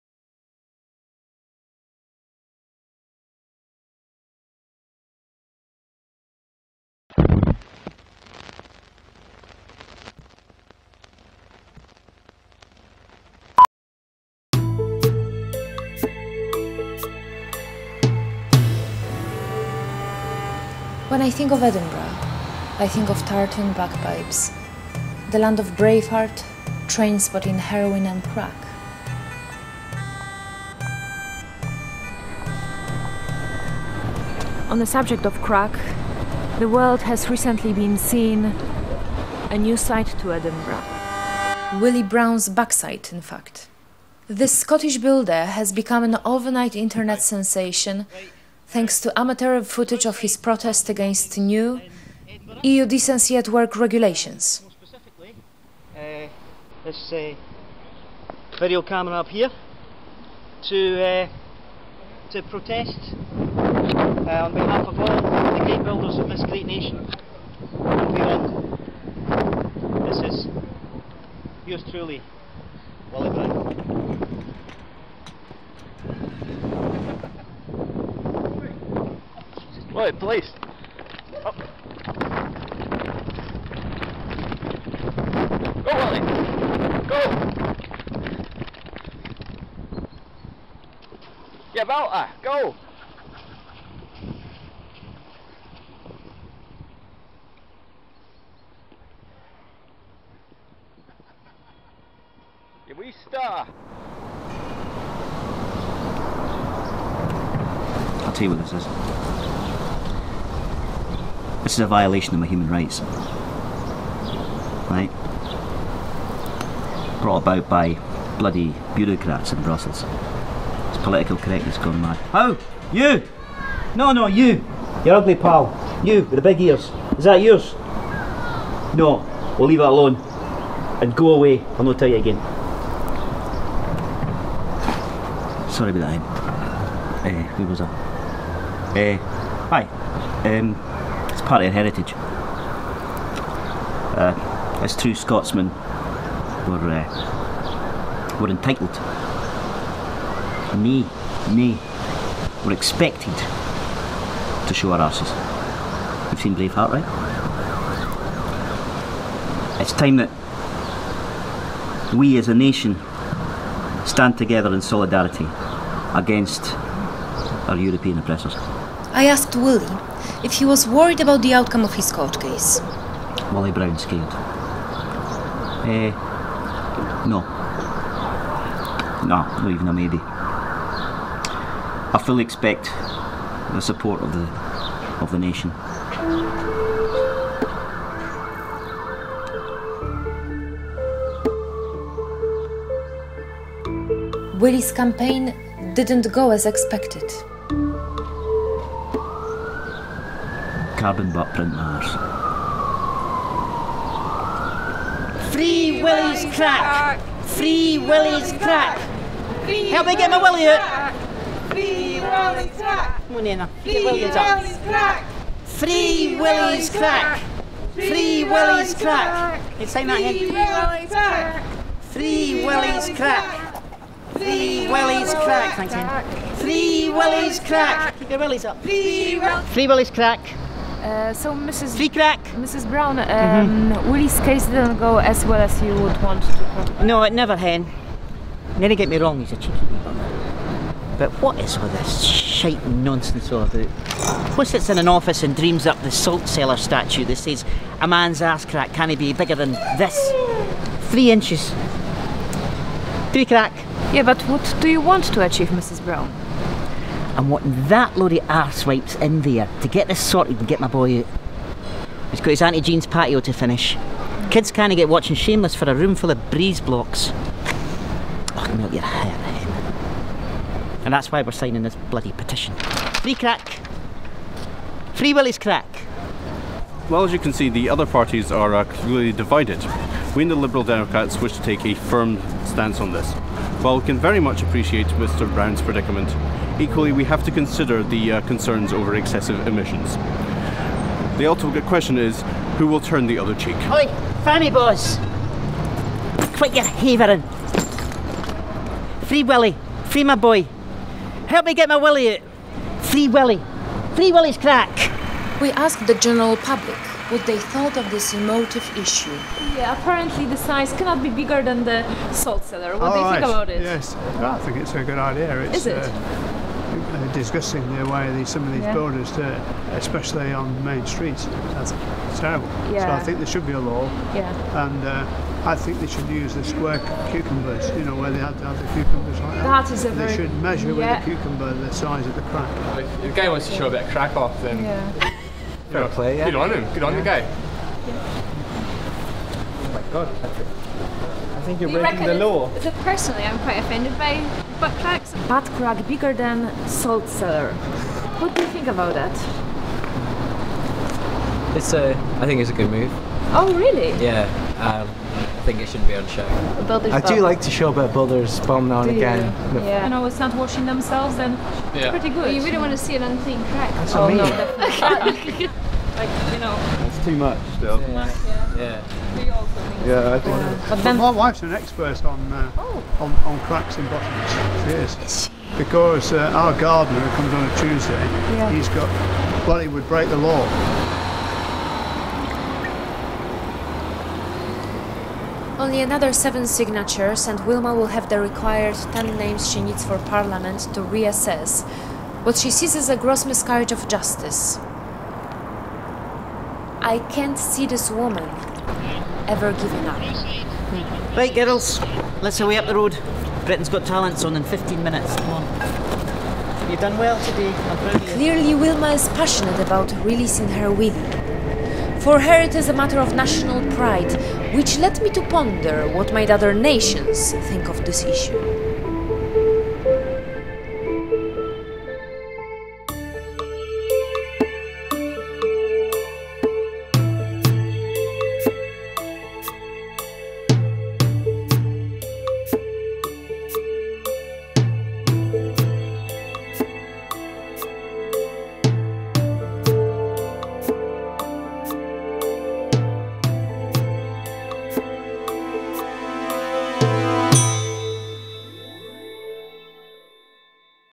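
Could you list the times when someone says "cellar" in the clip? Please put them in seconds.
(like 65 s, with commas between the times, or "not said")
246 s, 312 s, 347 s.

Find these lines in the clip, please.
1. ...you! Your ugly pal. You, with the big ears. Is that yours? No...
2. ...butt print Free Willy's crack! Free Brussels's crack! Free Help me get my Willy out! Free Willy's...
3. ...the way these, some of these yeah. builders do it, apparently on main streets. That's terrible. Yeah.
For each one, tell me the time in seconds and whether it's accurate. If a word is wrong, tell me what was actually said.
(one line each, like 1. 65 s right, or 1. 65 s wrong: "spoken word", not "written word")
1. 124 s right
2. 201 s wrong: "Willy", not "Brussels"
3. 317 s wrong: "especially", not "apparently".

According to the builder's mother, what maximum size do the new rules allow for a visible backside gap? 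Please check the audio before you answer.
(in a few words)
3 inches.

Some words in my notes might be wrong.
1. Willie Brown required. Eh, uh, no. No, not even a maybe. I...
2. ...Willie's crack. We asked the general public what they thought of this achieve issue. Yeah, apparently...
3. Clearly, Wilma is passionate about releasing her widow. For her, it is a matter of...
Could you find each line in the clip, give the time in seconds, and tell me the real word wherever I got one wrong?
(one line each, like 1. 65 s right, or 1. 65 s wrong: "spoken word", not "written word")
1. 173 s wrong: "scared", not "required"
2. 304 s wrong: "emotive", not "achieve"
3. 408 s right.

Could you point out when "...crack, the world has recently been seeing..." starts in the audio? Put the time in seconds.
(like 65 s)
35 s.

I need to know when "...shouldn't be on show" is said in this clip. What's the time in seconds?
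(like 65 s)
355 s.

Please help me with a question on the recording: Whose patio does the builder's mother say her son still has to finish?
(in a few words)
Auntie Jean's.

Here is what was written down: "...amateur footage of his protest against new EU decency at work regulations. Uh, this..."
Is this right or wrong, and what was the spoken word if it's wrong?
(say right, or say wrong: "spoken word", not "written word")
right.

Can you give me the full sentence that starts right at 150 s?
Me, me, we're expected to show our asses.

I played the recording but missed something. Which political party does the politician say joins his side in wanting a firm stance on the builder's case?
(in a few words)
Liberal Democrats.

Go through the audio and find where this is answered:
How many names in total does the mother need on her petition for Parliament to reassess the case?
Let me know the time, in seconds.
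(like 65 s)
389 s.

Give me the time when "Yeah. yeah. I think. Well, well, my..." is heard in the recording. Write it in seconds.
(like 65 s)
369 s.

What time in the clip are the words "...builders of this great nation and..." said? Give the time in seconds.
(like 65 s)
65 s.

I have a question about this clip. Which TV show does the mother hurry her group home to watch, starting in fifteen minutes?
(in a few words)
Britain's Got Talent.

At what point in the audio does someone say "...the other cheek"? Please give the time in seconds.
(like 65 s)
293 s.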